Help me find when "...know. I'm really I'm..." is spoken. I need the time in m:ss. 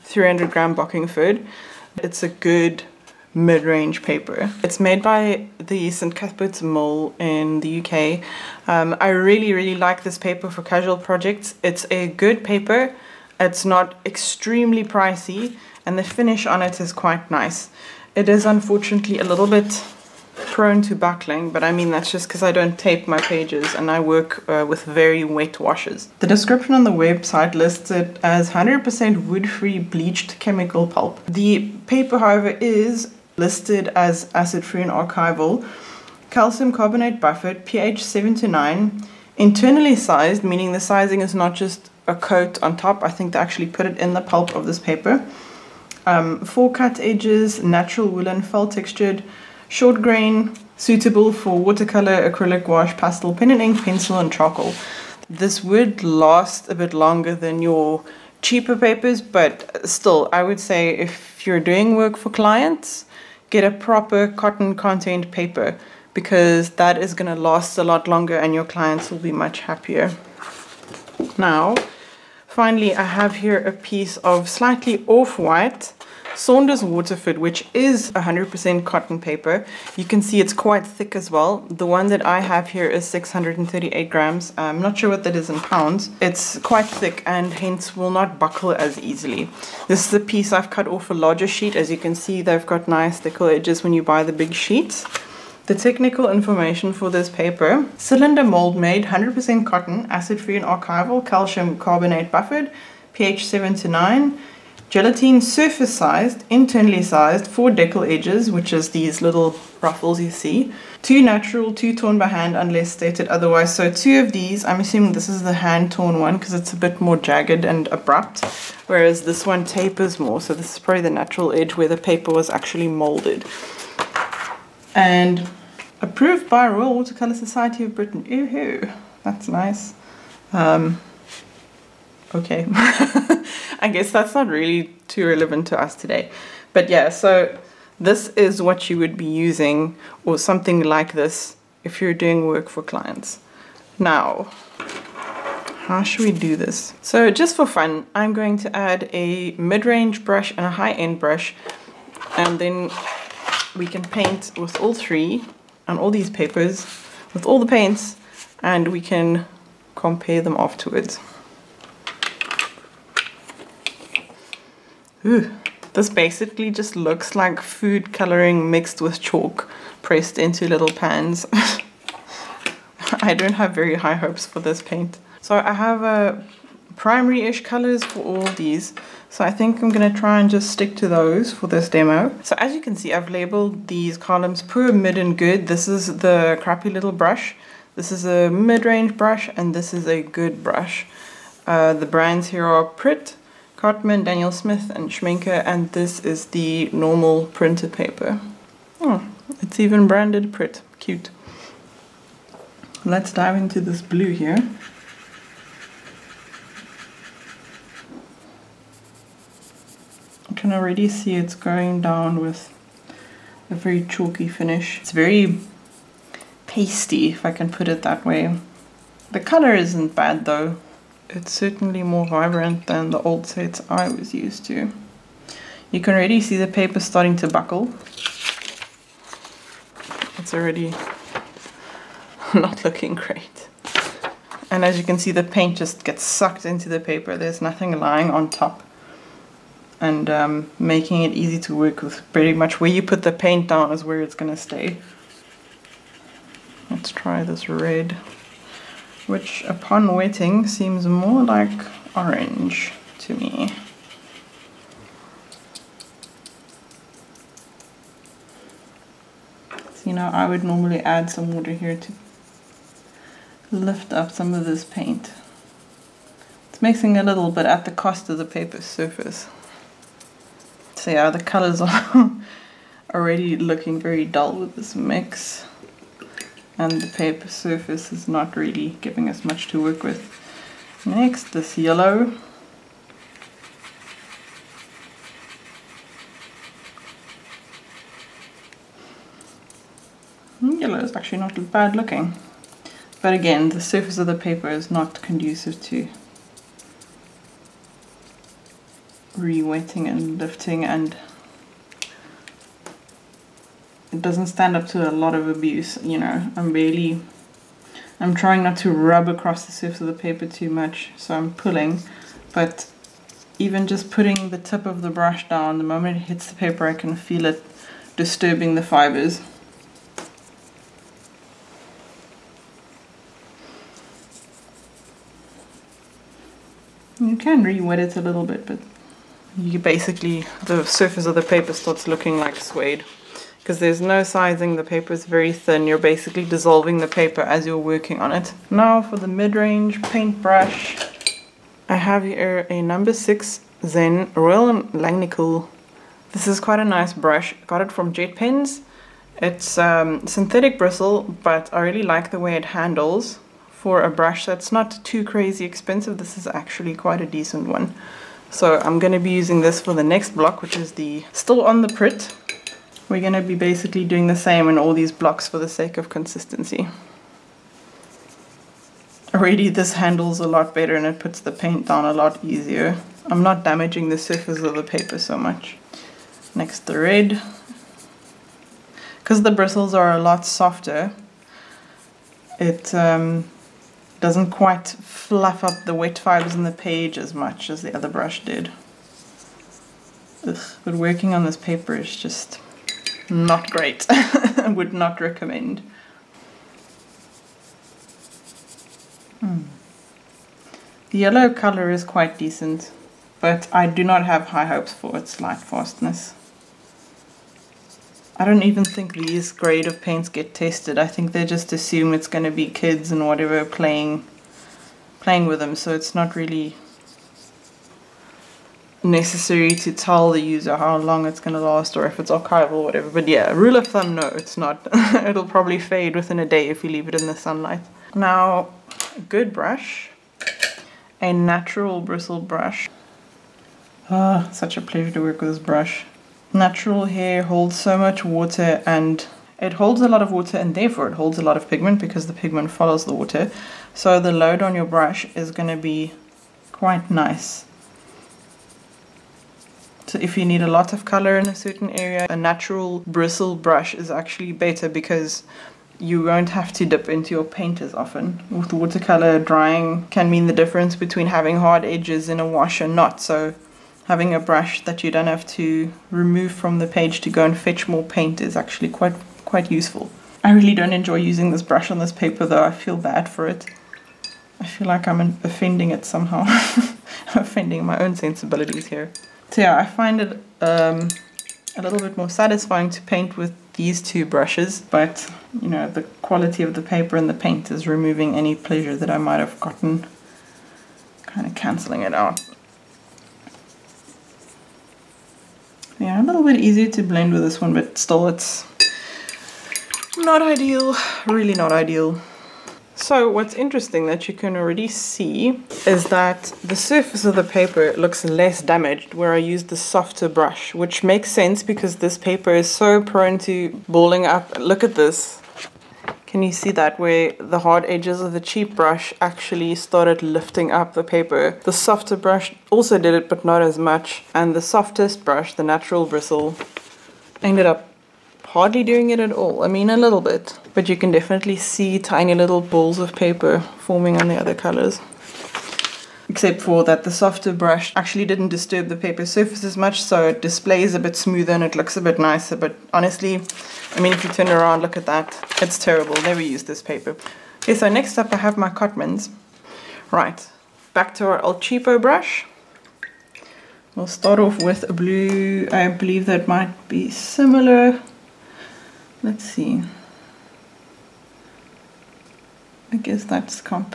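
5:06.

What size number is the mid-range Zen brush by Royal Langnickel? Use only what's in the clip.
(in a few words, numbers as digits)
6.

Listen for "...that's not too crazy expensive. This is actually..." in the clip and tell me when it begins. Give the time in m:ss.
5:54.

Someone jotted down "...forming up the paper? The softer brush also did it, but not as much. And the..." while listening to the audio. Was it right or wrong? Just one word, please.
wrong.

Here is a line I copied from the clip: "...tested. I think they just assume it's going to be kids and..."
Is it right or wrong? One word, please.
right.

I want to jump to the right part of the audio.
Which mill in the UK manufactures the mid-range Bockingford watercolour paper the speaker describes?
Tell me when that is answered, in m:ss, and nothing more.
0:05.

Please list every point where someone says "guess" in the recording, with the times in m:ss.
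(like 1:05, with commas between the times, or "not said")
2:13, 9:22.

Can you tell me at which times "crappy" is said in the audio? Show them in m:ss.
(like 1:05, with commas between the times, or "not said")
3:06.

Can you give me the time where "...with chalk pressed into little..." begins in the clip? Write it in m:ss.
2:49.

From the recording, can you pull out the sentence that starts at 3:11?
Uh, the brands here are Pritt, Cotman, Daniel Smith, and Schmincke, and this is the normal printed paper.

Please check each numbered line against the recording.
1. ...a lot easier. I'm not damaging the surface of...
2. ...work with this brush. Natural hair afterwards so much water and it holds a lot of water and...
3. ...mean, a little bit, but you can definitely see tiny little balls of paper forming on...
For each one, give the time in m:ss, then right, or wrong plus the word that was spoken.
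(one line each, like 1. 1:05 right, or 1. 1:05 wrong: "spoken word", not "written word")
1. 6:12 right
2. 7:15 wrong: "holds", not "afterwards"
3. 8:49 right.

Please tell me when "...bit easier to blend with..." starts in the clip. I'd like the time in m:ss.
8:16.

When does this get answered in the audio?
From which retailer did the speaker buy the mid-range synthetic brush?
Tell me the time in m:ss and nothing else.
5:48.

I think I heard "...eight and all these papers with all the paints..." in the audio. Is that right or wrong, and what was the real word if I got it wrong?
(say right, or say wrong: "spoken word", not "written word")
wrong: "three", not "eight".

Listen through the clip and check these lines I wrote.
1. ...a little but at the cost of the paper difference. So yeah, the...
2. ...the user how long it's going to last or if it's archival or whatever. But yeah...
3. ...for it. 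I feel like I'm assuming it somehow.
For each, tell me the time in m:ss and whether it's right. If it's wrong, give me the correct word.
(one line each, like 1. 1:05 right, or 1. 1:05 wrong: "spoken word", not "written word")
1. 4:27 wrong: "surface", not "difference"
2. 7:00 right
3. 7:53 wrong: "offending", not "assuming".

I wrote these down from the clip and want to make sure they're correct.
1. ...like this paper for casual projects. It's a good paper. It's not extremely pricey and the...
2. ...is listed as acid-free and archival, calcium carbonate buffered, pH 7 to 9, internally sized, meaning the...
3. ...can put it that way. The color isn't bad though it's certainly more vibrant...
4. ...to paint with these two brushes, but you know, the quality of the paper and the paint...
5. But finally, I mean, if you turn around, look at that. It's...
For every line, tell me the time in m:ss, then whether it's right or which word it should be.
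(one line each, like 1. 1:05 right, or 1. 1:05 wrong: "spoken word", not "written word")
1. 0:09 right
2. 0:32 right
3. 3:37 right
4. 8:02 right
5. 9:02 wrong: "honestly", not "finally".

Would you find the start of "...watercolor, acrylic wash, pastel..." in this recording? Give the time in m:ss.
0:51.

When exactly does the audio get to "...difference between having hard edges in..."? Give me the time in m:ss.
7:40.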